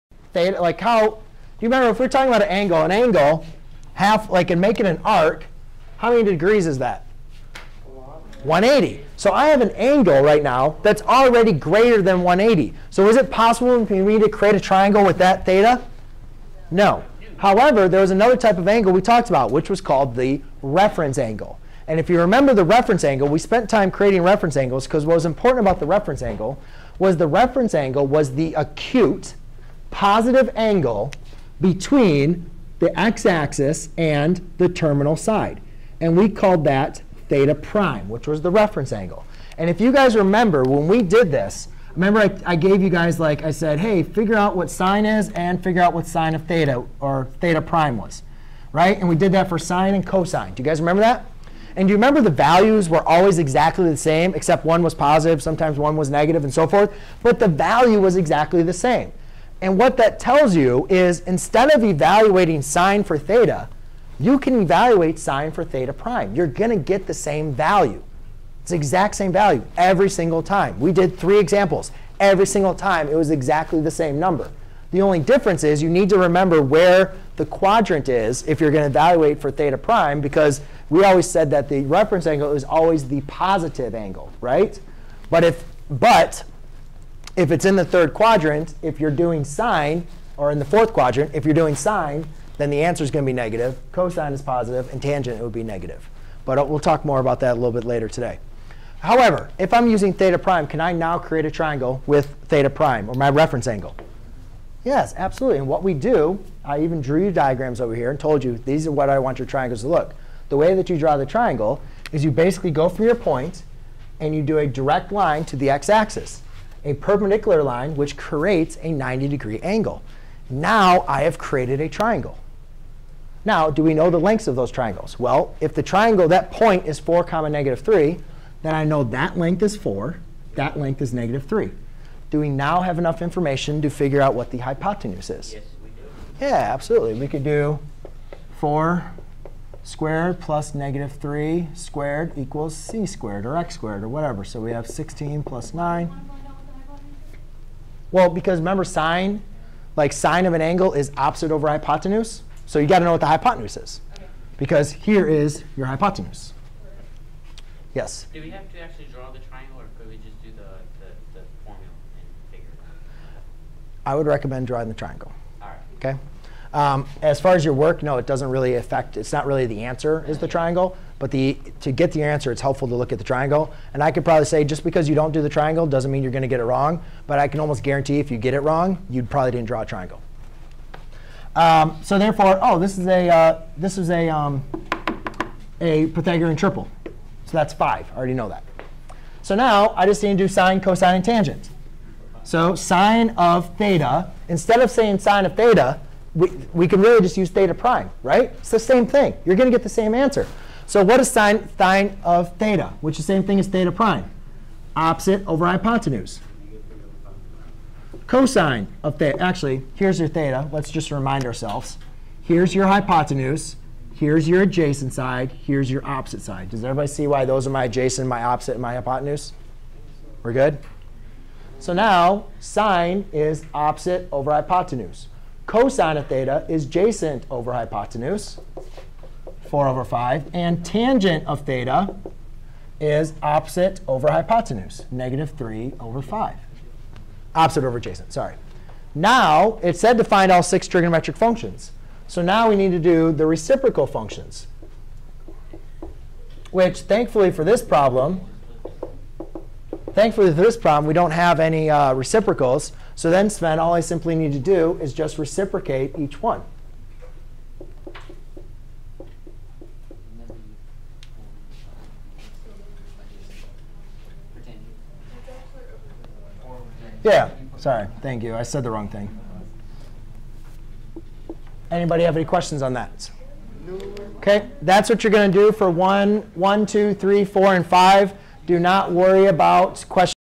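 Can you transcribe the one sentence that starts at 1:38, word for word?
However, if I'm using theta prime, can I now create a triangle with theta prime, or my reference angle?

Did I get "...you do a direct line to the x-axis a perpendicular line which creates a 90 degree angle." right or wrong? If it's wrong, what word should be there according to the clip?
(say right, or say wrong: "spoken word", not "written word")
right.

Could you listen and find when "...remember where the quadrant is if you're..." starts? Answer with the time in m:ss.
1:16.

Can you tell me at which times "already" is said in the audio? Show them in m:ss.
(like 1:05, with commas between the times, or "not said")
0:11, 3:08.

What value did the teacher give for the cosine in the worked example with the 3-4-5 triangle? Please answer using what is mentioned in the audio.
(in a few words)
4/5.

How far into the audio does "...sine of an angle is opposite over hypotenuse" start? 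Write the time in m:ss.
2:30.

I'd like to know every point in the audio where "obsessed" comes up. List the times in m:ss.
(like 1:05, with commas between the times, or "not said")
not said.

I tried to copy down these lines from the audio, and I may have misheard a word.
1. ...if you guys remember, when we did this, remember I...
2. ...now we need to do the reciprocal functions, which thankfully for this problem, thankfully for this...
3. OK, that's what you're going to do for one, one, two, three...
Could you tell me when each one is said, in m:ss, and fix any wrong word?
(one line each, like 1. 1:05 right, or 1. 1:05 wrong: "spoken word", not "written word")
1. 0:39 right
2. 4:02 right
3. 4:34 right.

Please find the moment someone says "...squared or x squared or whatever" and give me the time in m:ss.
2:23.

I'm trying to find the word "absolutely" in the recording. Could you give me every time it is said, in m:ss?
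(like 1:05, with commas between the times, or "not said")
1:45, 2:16.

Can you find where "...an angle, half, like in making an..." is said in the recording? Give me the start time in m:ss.
0:02.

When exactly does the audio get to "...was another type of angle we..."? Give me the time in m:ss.
0:18.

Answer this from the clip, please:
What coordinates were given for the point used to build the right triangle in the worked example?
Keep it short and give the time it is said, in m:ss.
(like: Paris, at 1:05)
4, -3, at 2:06.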